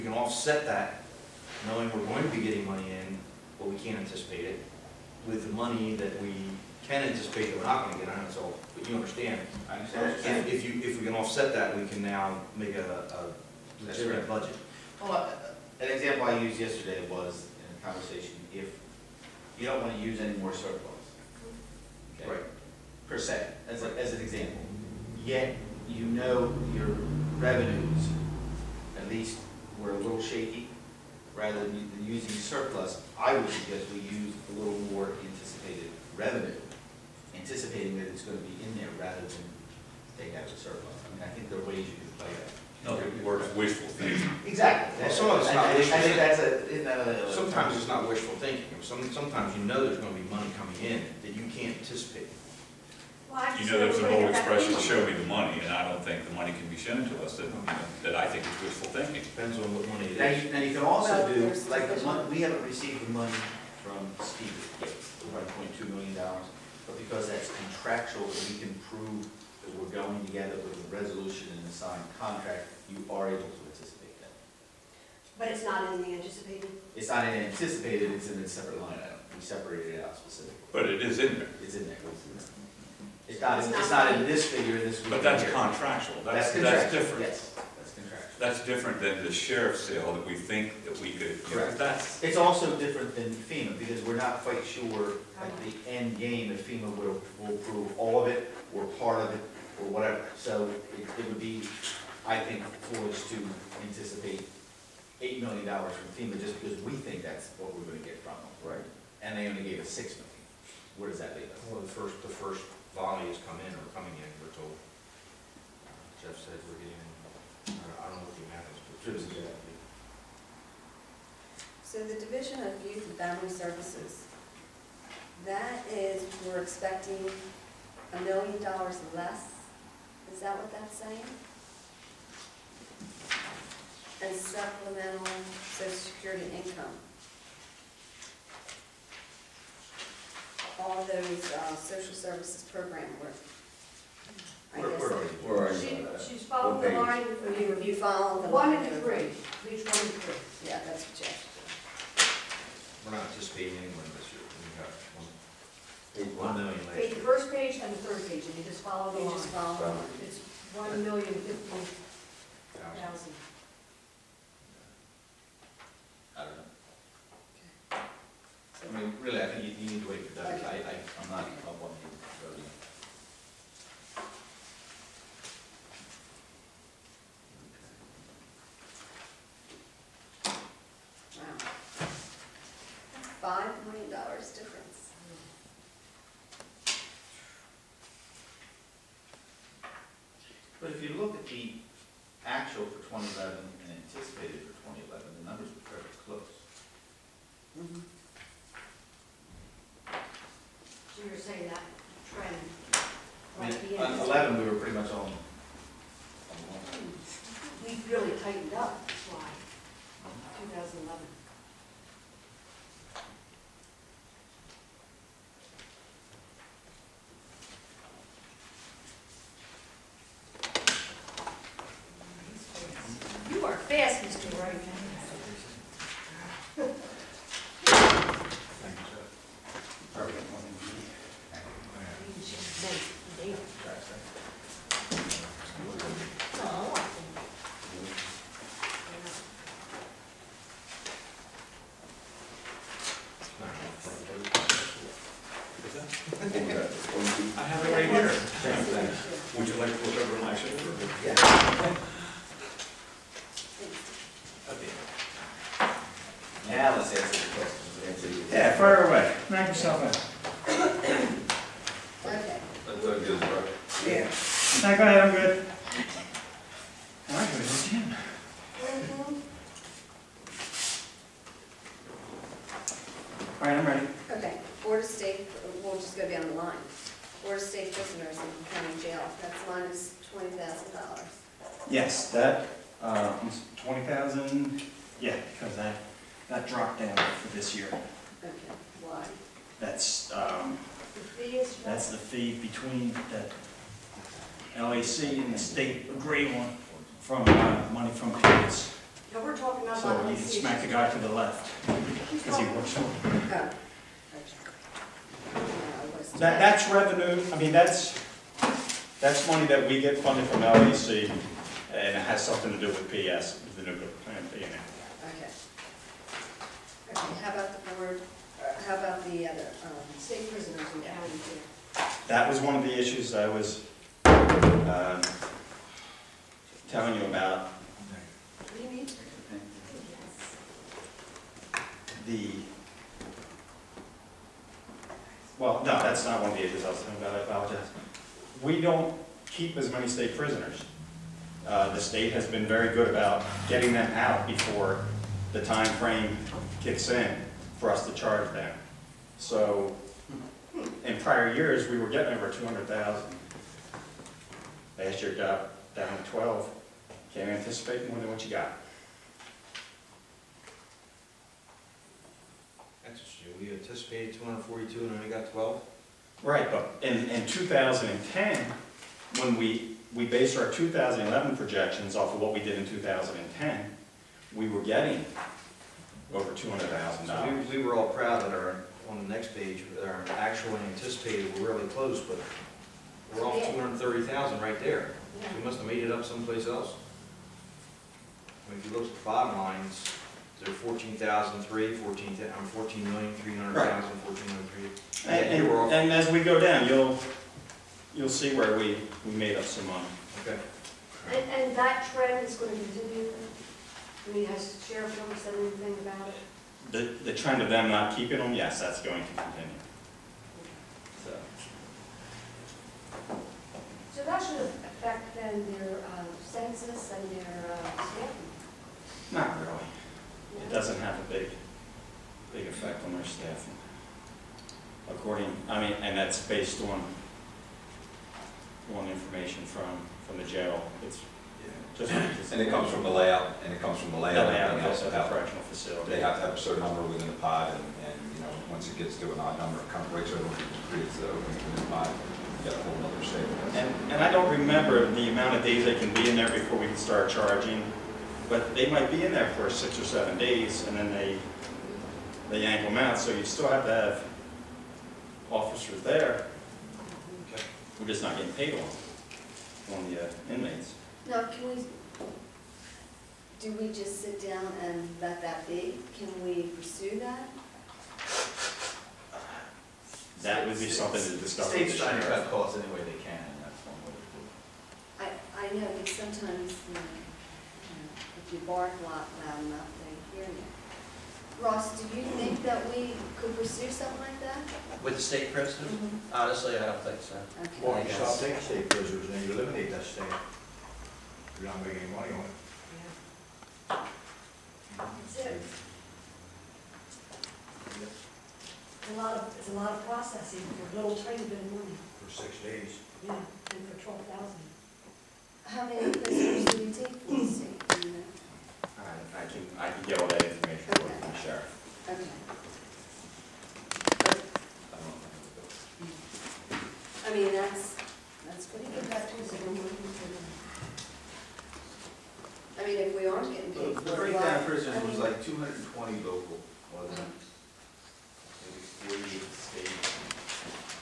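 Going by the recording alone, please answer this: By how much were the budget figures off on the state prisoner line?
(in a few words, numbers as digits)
$230,000.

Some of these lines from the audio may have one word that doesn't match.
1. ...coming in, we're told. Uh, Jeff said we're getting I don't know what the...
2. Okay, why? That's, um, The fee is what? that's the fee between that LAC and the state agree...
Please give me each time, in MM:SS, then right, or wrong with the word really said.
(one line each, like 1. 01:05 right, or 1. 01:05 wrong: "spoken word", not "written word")
1. 01:53 right
2. 04:48 right.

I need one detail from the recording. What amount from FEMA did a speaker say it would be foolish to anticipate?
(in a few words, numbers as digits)
8 million dollars.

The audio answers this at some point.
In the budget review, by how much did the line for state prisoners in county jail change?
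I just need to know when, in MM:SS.
04:39.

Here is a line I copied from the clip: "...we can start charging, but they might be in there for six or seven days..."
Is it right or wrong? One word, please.
right.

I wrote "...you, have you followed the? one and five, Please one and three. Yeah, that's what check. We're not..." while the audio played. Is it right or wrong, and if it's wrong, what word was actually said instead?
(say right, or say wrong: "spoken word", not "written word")
wrong: "three", not "five".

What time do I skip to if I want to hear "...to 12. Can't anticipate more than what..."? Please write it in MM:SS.
05:56.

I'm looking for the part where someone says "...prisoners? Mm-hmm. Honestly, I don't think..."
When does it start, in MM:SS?
08:05.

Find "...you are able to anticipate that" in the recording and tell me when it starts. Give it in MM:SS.
01:12.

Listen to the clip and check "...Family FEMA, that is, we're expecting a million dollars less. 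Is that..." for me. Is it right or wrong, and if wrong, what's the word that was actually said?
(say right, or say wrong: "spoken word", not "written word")
wrong: "Services", not "FEMA".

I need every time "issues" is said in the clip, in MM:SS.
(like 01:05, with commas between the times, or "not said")
05:22, 05:36.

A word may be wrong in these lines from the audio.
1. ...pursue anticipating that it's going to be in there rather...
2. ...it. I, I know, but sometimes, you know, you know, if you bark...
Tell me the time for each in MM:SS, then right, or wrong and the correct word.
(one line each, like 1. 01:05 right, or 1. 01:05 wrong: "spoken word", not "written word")
1. 00:36 wrong: "revenue", not "pursue"
2. 07:54 right.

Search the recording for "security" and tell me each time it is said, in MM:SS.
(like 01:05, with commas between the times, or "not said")
02:15.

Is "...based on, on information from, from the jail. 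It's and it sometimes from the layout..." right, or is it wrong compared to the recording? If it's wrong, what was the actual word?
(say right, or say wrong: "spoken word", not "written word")
wrong: "comes", not "sometimes".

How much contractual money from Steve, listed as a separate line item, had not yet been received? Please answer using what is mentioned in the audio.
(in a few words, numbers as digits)
$1.2 million.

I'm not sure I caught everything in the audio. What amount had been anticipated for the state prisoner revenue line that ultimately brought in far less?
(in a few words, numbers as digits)
242.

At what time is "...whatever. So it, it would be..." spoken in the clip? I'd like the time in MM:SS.
01:39.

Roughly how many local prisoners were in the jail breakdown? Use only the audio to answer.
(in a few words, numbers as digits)
220.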